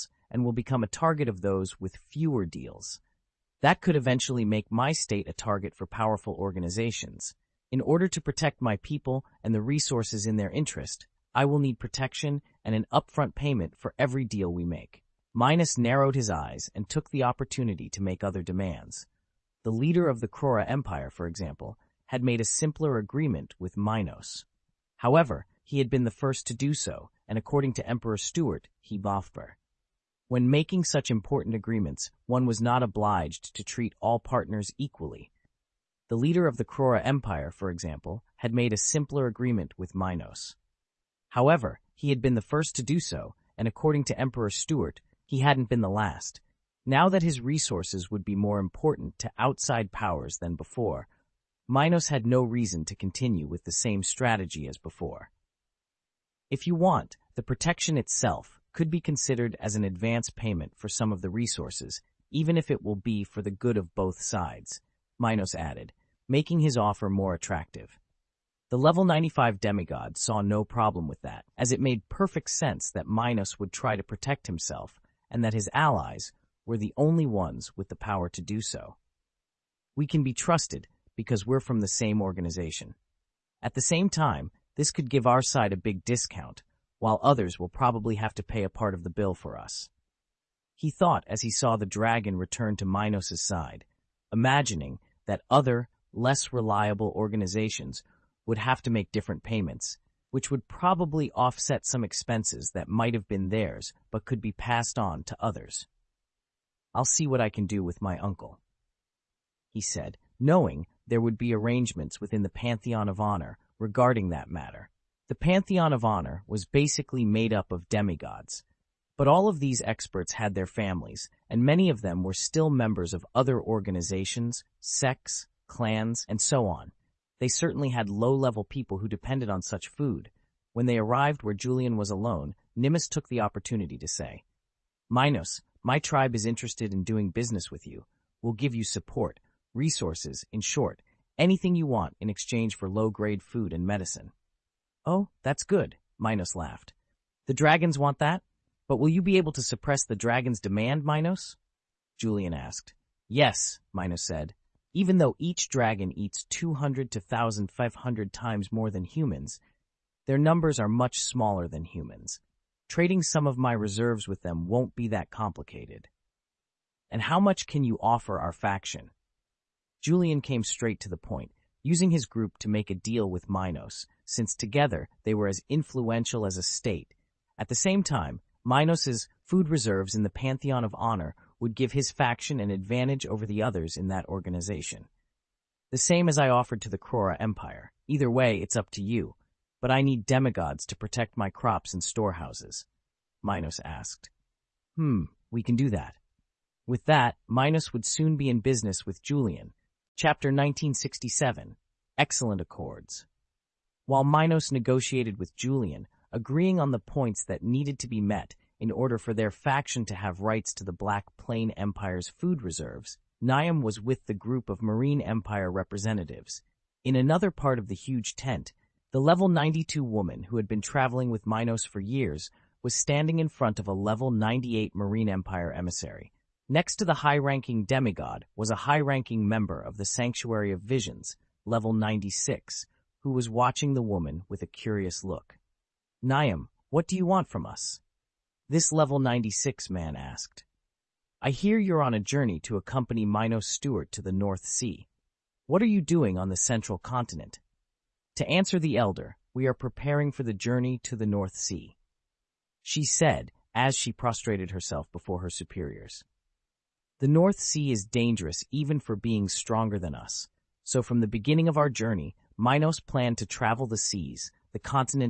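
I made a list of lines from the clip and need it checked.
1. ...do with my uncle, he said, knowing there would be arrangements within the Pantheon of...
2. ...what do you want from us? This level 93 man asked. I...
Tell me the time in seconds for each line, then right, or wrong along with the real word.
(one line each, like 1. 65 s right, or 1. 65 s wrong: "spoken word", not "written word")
1. 107 s right
2. 236 s wrong: "96", not "93".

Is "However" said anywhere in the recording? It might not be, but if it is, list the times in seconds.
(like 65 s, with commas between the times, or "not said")
24 s, 41 s.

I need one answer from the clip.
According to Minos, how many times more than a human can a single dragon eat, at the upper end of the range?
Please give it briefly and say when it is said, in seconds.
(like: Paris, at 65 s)
1,500, at 157 s.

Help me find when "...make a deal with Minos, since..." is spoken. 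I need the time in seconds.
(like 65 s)
172 s.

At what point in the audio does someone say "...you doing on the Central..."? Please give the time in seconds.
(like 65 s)
245 s.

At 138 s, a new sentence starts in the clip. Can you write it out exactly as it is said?
We'll give you support, resources, in short, Anything you want in exchange for low-grade food and medicine.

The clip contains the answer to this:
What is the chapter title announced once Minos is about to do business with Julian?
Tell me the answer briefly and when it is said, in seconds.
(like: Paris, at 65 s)
Excellent Accords, at 202 s.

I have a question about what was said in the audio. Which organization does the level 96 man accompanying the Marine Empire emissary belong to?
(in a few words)
Sanctuary of Visions.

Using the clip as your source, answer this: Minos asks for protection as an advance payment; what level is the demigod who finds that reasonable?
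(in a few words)
95.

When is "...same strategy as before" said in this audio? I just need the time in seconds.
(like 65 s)
53 s.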